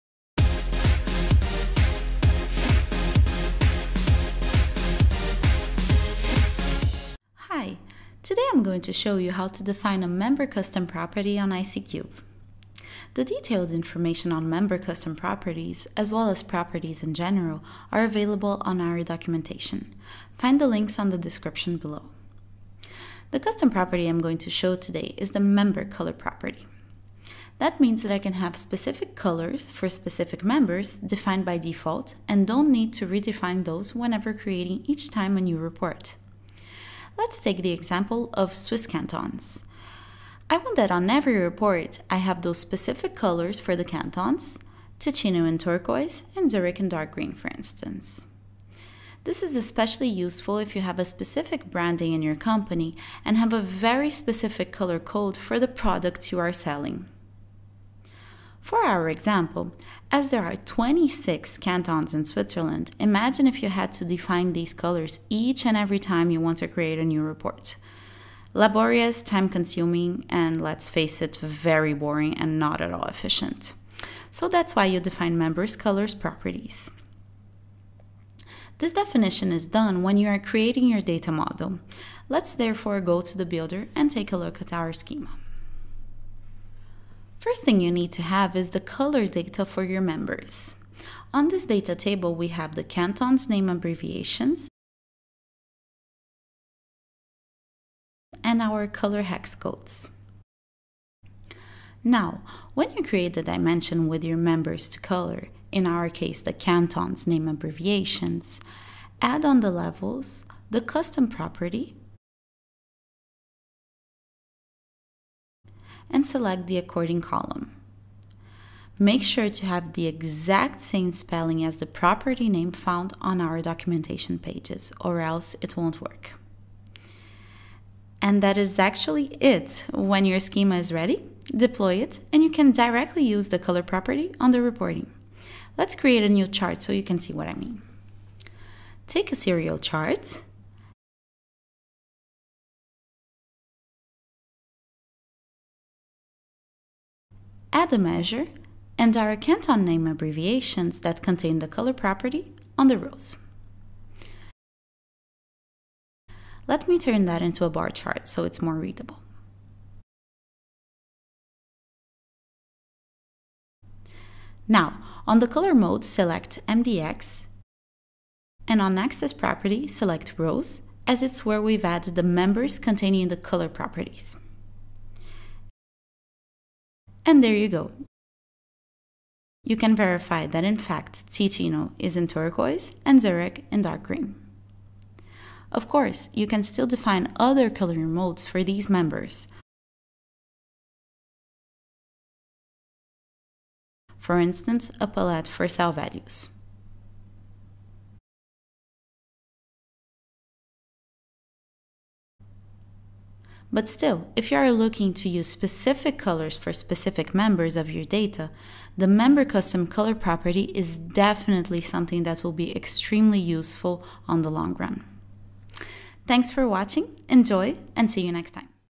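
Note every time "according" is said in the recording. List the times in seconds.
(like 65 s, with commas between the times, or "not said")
116 s.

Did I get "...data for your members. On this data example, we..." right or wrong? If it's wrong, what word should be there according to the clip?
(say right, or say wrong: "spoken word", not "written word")
wrong: "table", not "example".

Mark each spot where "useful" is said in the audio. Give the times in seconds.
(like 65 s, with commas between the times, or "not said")
50 s, 213 s.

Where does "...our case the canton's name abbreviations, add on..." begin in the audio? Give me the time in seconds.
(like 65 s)
105 s.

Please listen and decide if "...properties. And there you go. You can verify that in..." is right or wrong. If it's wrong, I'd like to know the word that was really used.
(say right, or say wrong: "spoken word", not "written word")
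right.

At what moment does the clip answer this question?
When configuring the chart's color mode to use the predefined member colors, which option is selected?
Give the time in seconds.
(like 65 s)
166 s.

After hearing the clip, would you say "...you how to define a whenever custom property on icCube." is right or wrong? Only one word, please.
wrong.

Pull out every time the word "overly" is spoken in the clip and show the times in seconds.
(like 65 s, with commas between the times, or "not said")
not said.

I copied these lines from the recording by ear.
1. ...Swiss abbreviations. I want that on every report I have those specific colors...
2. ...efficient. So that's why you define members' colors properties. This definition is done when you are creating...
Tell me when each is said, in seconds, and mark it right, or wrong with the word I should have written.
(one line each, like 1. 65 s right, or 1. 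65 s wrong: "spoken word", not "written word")
1. 38 s wrong: "cantons", not "abbreviations"
2. 73 s right.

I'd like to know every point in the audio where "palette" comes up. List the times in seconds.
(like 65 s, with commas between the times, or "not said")
195 s.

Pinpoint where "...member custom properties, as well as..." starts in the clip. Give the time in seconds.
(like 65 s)
14 s.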